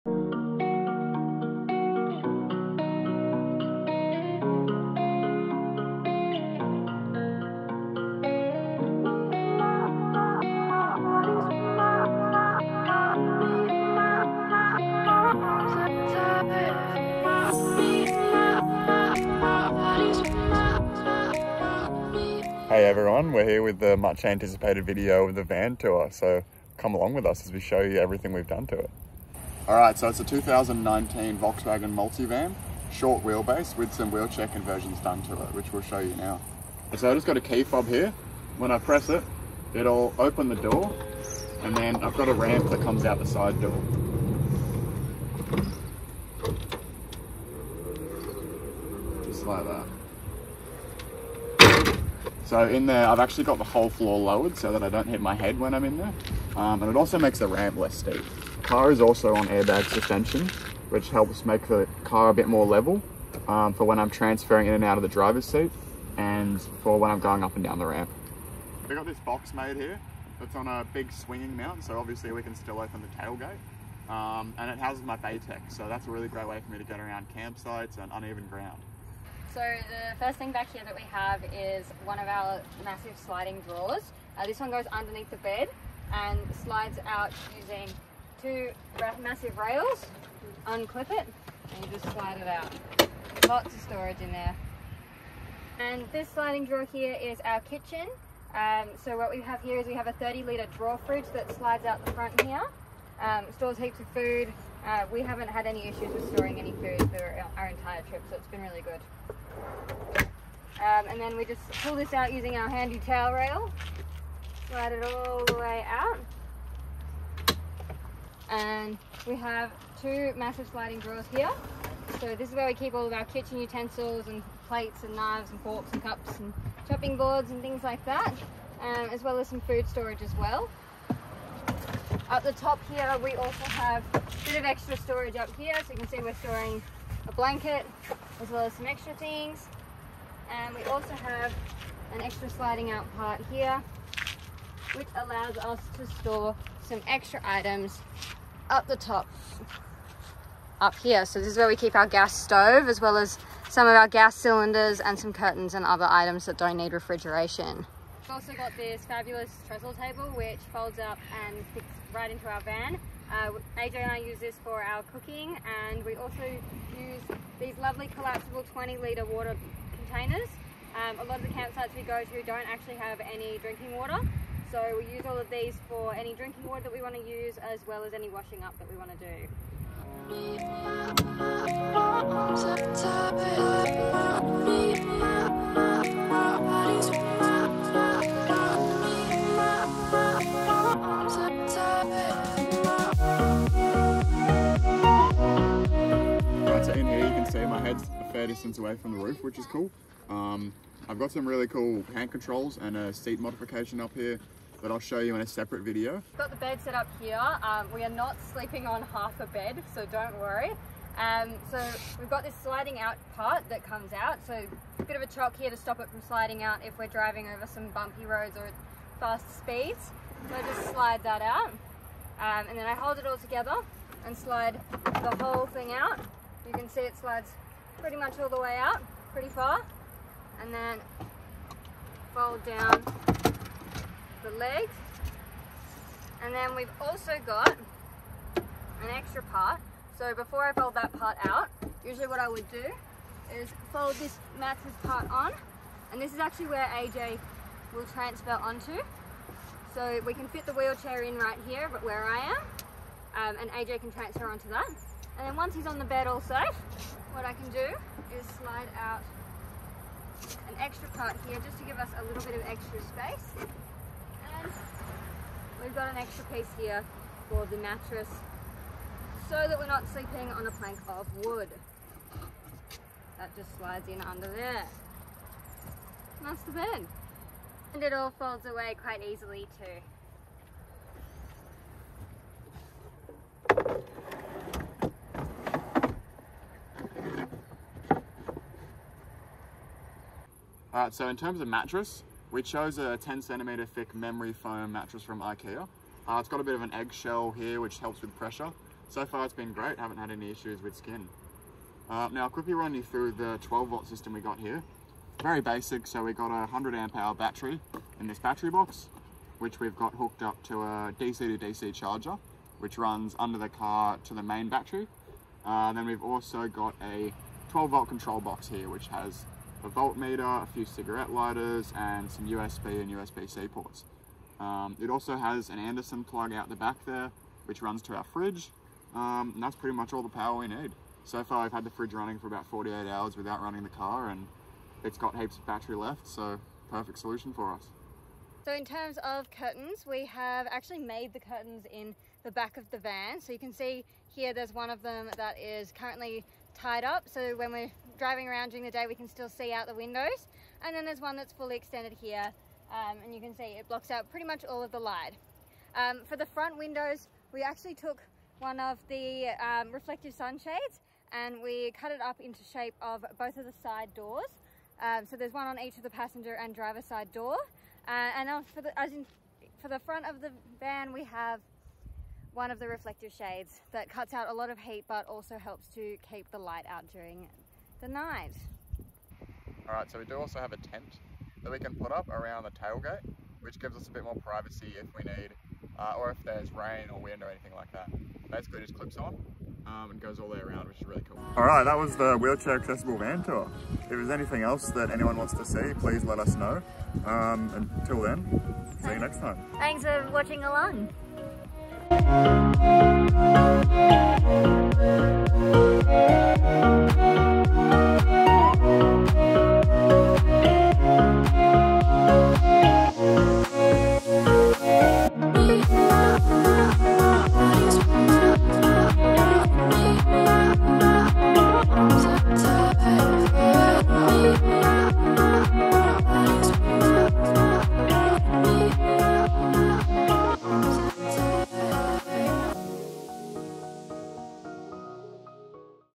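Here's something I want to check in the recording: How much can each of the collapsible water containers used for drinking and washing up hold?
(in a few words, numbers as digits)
20 litres.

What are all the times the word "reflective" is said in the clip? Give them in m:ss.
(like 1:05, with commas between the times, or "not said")
5:59, 6:12.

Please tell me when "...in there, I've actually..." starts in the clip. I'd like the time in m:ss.
0:52.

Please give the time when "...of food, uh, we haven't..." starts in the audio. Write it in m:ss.
1:43.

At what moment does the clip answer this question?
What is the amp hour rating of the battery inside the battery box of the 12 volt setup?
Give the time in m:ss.
5:06.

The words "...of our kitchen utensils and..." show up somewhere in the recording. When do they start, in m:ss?
2:03.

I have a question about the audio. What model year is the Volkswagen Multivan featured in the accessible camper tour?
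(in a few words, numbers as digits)
2019.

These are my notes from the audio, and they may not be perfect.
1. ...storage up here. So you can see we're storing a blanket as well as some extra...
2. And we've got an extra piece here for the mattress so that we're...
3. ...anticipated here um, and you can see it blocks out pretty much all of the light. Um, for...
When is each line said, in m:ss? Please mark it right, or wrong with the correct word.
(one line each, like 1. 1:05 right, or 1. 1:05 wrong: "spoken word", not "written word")
1. 2:14 right
2. 4:23 right
3. 5:51 wrong: "extended", not "anticipated".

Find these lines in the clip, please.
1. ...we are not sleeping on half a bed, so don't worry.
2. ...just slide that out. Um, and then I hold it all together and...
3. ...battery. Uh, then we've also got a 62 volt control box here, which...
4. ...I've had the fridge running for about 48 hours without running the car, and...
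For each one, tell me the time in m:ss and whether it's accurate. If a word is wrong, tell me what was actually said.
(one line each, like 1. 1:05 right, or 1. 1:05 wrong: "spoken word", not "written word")
1. 3:27 right
2. 3:40 right
3. 5:14 wrong: "12", not "62"
4. 5:31 right.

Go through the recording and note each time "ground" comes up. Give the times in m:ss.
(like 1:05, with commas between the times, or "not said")
1:18.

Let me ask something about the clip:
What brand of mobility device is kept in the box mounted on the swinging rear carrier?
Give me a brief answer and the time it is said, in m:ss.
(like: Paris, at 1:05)
Batec, at 1:15.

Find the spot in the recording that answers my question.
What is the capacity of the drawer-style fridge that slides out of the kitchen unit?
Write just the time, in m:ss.
1:40.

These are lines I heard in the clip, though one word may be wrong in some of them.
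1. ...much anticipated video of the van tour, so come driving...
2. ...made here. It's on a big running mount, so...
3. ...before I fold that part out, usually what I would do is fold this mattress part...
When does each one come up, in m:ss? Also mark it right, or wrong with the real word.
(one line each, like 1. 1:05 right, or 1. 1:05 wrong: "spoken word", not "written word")
1. 0:23 wrong: "along", not "driving"
2. 1:09 wrong: "swinging", not "running"
3. 4:00 right.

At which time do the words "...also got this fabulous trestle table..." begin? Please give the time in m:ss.
2:38.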